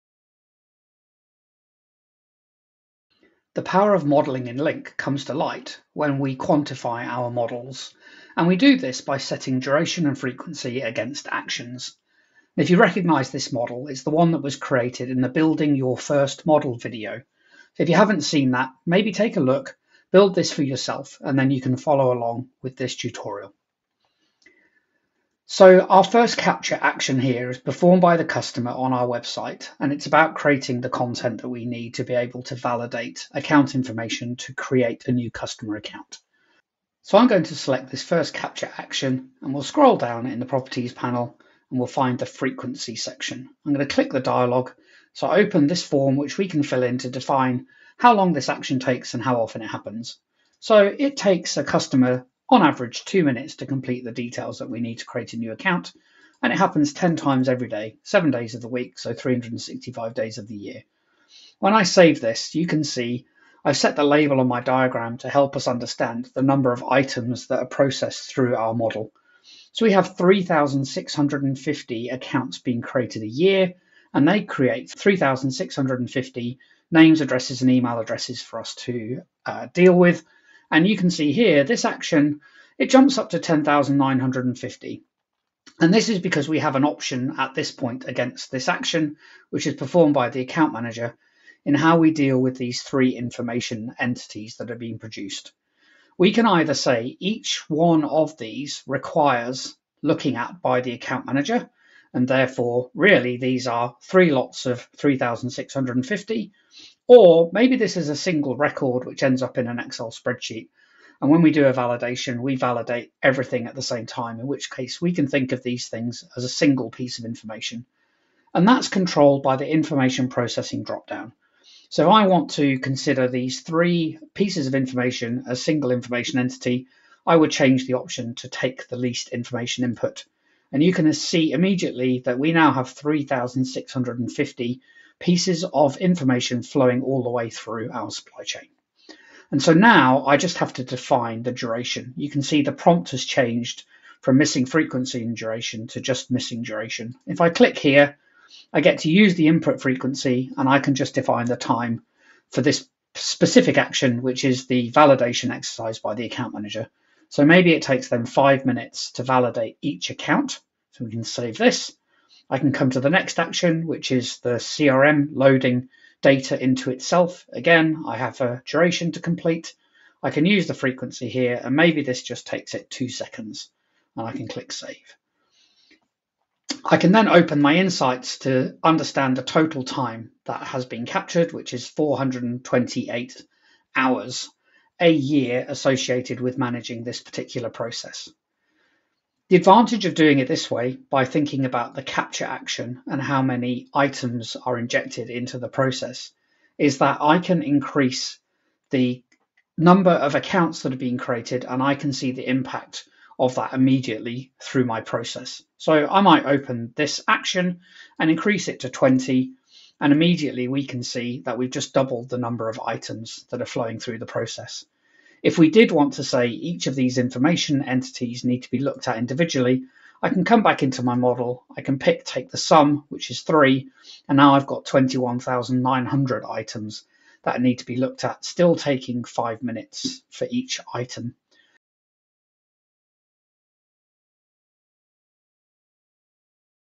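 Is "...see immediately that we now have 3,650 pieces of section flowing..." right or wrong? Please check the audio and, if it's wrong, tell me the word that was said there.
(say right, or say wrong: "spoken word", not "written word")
wrong: "information", not "section".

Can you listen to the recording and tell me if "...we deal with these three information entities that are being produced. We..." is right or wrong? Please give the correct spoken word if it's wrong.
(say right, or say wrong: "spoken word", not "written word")
right.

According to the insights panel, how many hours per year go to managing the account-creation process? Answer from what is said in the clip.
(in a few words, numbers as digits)
428 hours.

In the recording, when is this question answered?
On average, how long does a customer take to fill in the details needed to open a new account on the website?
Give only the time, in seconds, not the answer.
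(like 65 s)
53 s.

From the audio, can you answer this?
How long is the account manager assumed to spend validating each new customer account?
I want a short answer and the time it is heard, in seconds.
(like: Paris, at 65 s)
5 minutes, at 158 s.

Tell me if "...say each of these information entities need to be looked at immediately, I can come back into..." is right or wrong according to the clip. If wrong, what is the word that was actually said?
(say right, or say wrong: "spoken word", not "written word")
wrong: "individually", not "immediately".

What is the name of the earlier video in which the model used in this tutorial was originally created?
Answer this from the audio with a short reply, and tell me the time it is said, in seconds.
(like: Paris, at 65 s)
Building Your First Model, at 15 s.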